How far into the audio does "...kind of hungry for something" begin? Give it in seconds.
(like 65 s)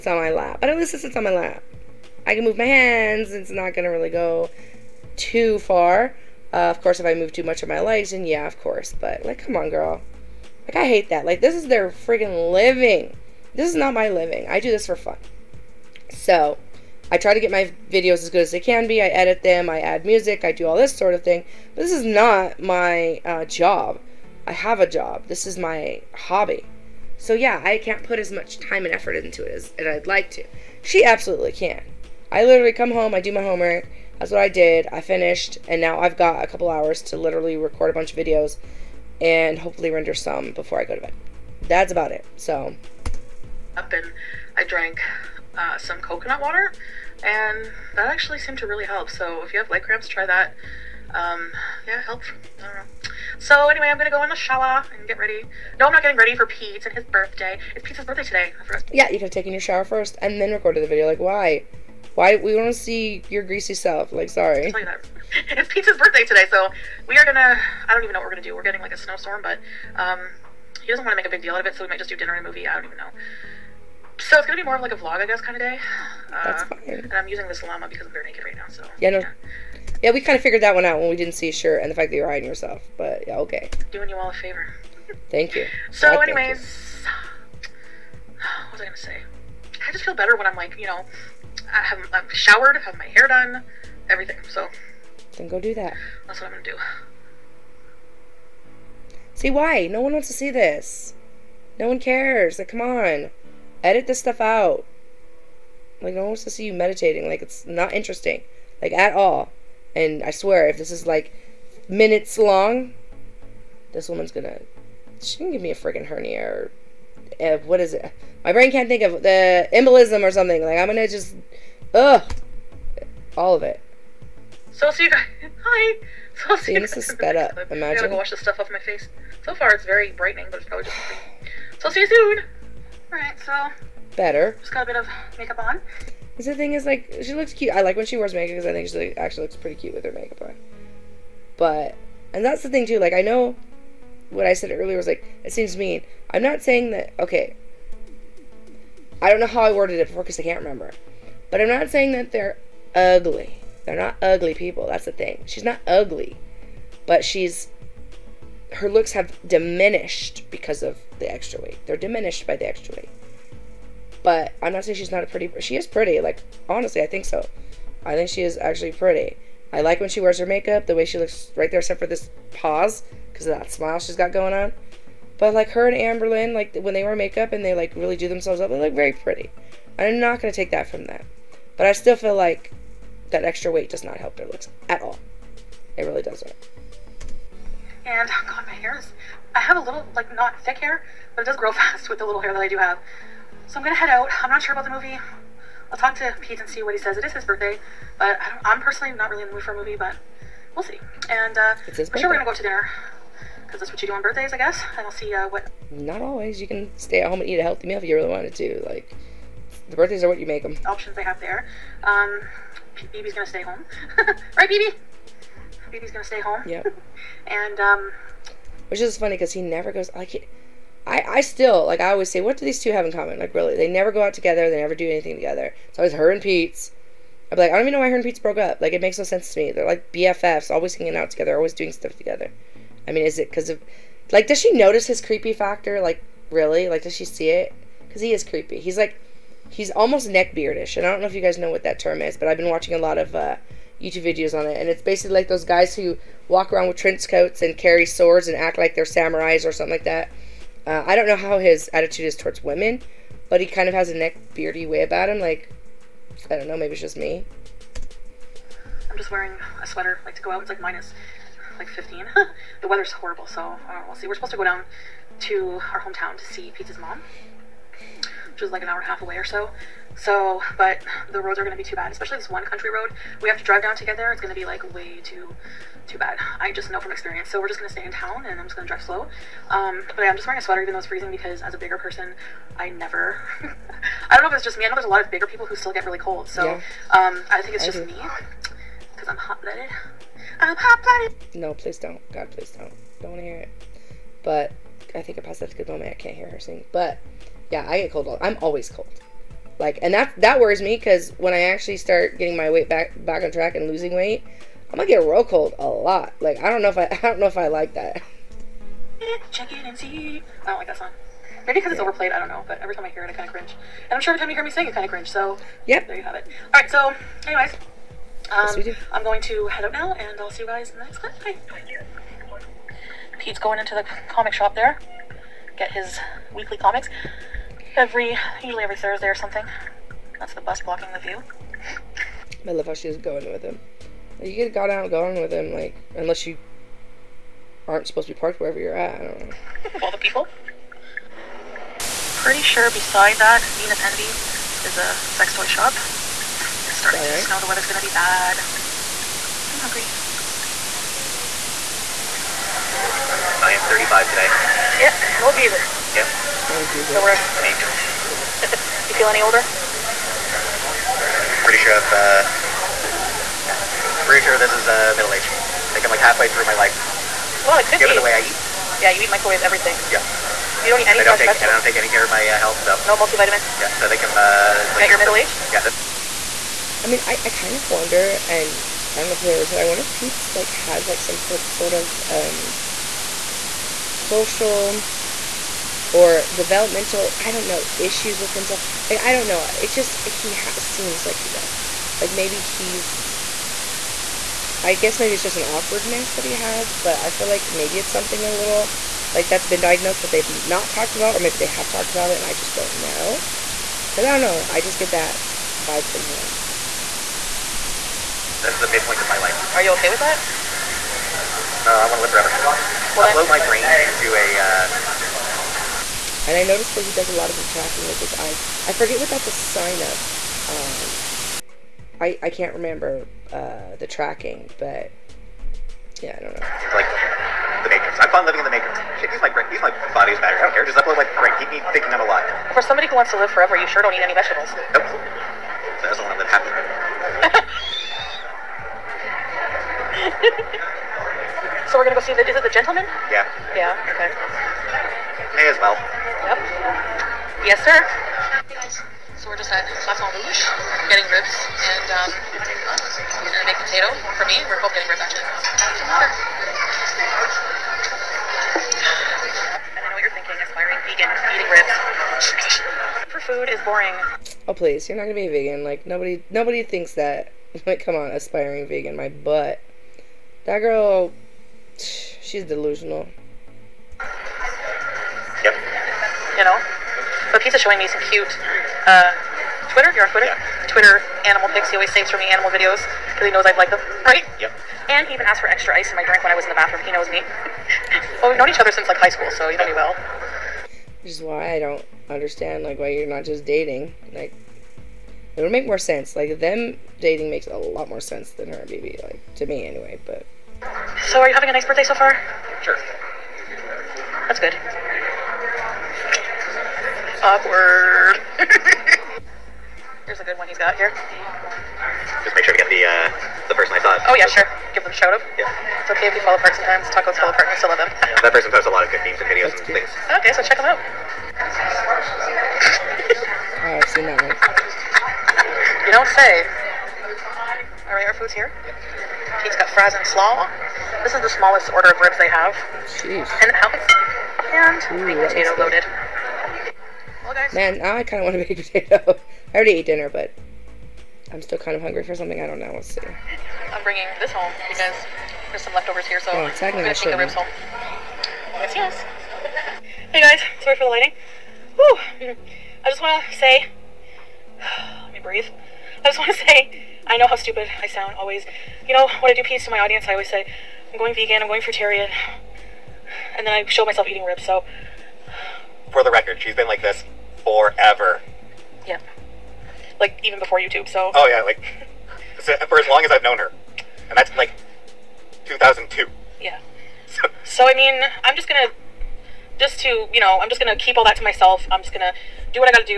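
541 s.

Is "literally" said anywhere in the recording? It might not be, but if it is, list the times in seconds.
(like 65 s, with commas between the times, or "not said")
32 s, 37 s.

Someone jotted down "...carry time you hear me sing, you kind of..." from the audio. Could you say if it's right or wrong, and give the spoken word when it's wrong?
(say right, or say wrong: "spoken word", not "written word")
wrong: "every", not "carry".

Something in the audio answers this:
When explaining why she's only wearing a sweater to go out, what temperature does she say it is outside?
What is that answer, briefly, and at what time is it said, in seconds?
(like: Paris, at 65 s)
-15, at 260 s.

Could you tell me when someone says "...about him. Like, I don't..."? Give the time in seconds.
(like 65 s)
255 s.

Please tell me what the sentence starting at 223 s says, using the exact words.
Like, really, they never go out together.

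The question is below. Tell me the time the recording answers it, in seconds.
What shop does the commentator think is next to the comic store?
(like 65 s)
343 s.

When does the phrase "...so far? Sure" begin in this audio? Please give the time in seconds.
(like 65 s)
502 s.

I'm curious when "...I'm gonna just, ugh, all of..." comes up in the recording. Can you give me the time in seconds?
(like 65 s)
120 s.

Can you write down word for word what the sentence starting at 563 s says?
And then I show myself eating ribs, so.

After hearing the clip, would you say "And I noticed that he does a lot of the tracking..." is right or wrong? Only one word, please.
right.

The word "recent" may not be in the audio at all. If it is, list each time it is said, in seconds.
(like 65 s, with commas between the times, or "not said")
not said.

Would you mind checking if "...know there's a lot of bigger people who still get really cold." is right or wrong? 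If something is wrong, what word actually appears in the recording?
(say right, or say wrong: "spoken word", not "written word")
right.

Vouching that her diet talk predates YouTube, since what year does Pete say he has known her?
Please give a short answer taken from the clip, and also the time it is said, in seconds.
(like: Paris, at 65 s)
2002, at 575 s.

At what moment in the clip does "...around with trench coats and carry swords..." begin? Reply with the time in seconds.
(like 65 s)
246 s.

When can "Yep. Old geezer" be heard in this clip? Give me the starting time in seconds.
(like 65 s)
356 s.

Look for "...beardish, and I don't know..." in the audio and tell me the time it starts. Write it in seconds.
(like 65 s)
240 s.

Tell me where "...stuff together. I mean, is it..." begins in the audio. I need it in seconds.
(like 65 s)
231 s.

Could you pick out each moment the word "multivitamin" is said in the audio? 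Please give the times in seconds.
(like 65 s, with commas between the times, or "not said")
373 s.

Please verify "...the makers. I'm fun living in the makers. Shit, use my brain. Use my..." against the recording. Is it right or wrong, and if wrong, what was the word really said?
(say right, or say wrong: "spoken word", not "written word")
right.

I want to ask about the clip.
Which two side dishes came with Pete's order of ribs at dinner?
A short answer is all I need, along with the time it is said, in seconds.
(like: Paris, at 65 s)
fries and slaw, at 529 s.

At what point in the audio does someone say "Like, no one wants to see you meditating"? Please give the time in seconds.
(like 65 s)
106 s.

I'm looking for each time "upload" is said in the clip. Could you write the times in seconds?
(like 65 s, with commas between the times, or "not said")
413 s, 431 s.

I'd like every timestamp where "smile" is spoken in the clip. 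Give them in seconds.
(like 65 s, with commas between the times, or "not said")
173 s.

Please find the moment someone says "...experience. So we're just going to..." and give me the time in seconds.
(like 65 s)
277 s.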